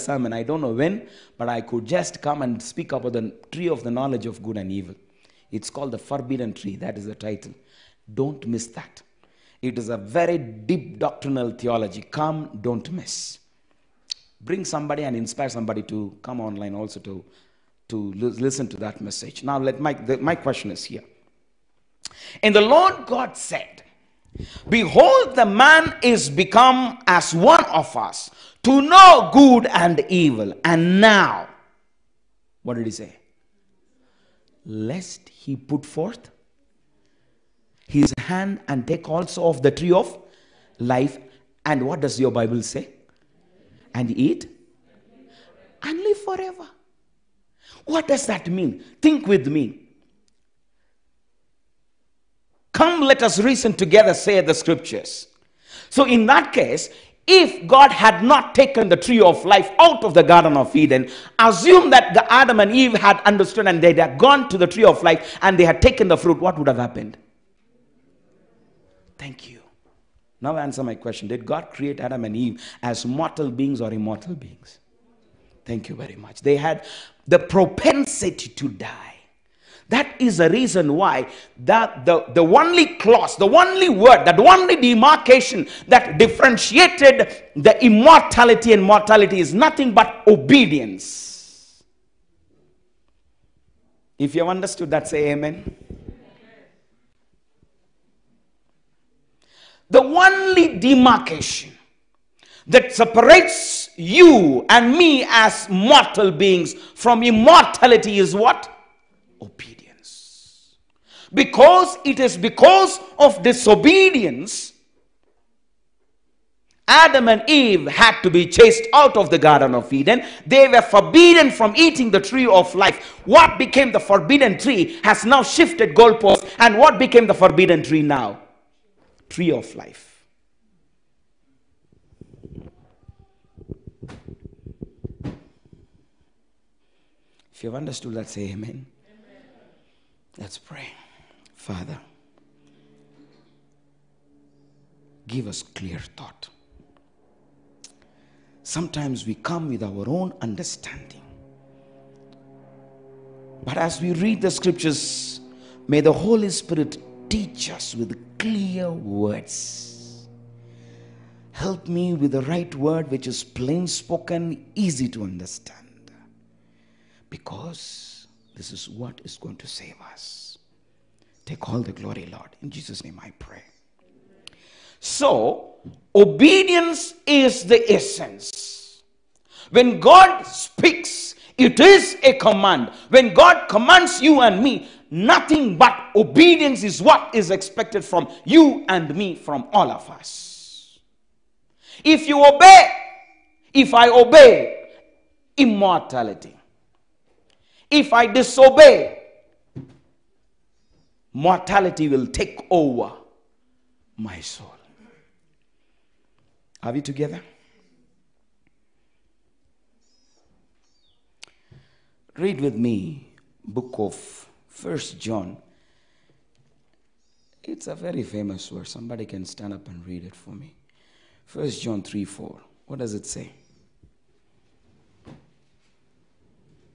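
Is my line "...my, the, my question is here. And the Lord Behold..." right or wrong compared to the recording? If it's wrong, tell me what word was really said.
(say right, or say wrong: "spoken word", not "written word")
wrong: "God", not "Behold".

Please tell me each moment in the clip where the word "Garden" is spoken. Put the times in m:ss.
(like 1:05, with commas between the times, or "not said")
1:00, 1:59.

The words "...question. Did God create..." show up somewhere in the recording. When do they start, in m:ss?
1:10.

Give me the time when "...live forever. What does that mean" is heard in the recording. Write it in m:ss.
0:45.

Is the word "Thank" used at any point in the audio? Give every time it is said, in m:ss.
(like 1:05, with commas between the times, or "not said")
1:09, 1:15.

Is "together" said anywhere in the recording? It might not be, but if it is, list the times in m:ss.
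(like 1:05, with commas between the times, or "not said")
0:53, 3:27.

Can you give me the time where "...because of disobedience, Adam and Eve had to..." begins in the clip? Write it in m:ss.
1:52.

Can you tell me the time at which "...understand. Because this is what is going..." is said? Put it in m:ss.
2:45.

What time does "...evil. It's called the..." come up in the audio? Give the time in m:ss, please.
0:04.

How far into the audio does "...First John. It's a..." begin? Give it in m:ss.
3:34.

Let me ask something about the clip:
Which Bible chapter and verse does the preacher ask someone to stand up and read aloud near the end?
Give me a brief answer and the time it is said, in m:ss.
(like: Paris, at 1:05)
1 John 3:4, at 3:41.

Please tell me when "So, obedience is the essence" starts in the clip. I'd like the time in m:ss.
2:54.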